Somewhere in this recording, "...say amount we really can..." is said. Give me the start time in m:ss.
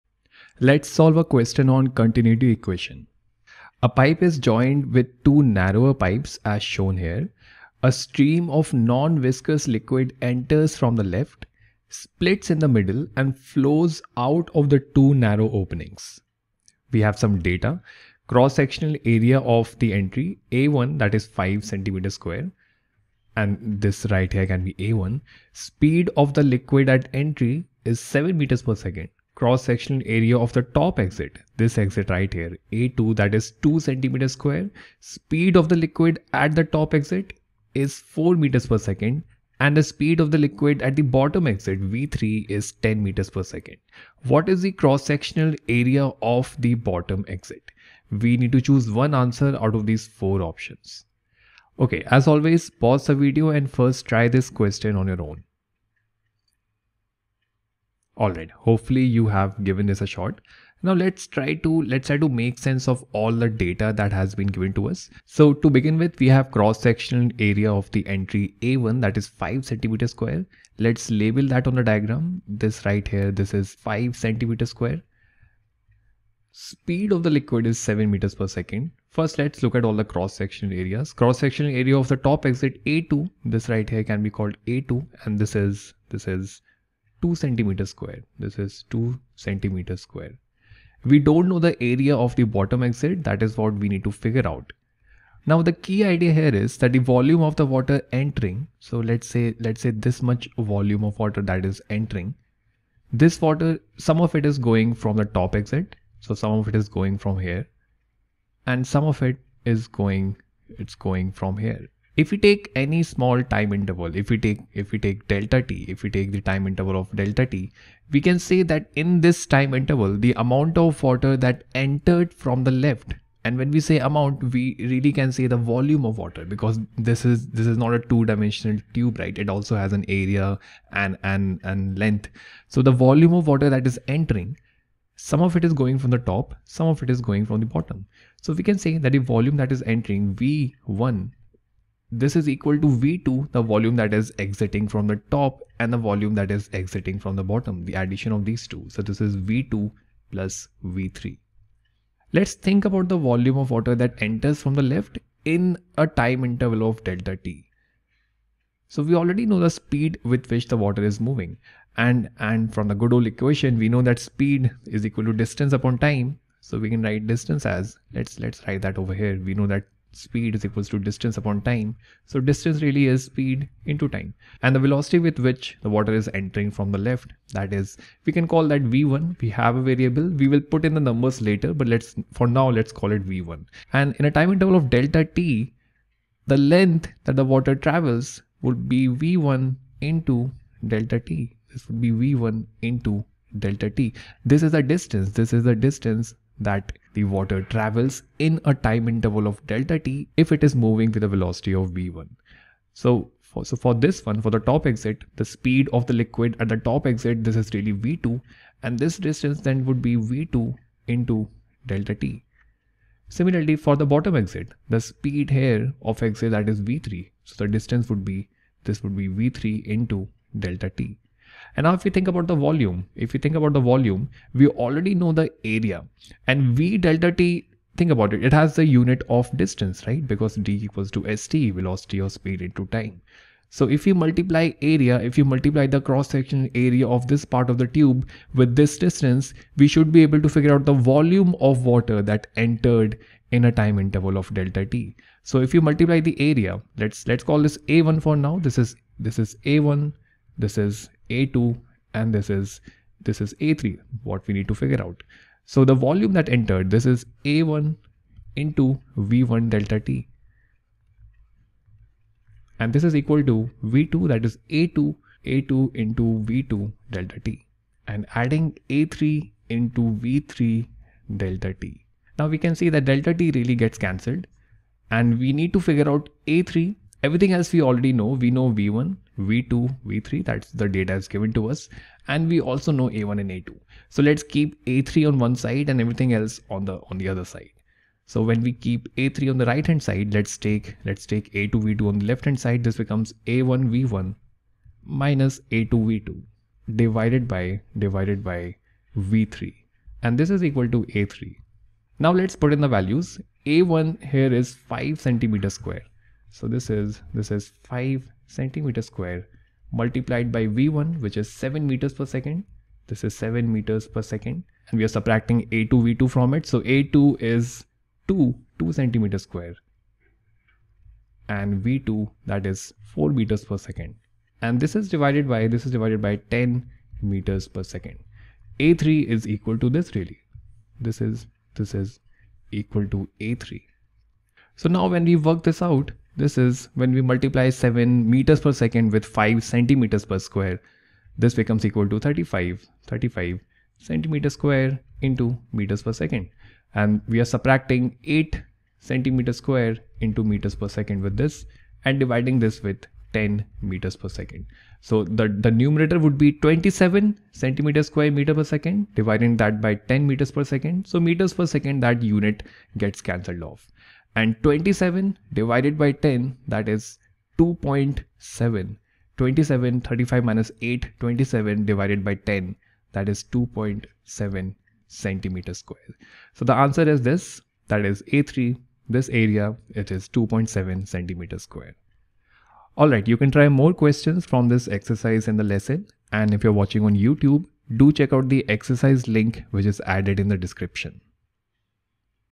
2:03.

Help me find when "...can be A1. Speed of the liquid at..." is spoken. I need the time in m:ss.
0:24.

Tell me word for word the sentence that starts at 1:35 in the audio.
Now the key idea here is that the volume of the water entering.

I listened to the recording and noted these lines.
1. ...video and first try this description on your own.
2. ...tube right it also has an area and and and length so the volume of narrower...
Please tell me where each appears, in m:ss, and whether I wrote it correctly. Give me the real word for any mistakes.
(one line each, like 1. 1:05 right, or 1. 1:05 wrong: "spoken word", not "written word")
1. 0:53 wrong: "question", not "description"
2. 2:08 wrong: "water", not "narrower".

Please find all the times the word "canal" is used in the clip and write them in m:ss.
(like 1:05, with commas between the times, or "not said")
not said.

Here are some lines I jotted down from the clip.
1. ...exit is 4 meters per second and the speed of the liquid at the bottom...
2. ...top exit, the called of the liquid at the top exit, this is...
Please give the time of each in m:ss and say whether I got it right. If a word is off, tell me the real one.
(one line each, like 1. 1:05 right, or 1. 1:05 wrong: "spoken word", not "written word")
1. 0:36 right
2. 3:24 wrong: "speed", not "called".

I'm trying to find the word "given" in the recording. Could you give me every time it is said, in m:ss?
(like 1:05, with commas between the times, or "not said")
0:59, 1:04, 4:41.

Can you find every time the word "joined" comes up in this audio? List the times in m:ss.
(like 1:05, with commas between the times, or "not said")
0:04.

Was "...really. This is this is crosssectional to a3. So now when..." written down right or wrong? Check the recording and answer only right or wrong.
wrong.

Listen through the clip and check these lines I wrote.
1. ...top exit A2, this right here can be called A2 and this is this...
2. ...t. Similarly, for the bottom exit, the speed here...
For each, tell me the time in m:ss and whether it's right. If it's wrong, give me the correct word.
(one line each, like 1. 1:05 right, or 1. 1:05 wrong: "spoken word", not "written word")
1. 1:22 right
2. 3:32 right.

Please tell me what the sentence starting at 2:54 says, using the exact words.
And the velocity with which the water is entering from the left, that is, we can call that V1.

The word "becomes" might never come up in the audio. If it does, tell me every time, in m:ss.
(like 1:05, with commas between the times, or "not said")
4:53, 5:41.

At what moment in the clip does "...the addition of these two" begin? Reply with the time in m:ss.
2:27.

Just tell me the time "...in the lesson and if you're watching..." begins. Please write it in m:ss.
6:25.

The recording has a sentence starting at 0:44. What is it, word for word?
What is the cross-sectional area of the bottom exit?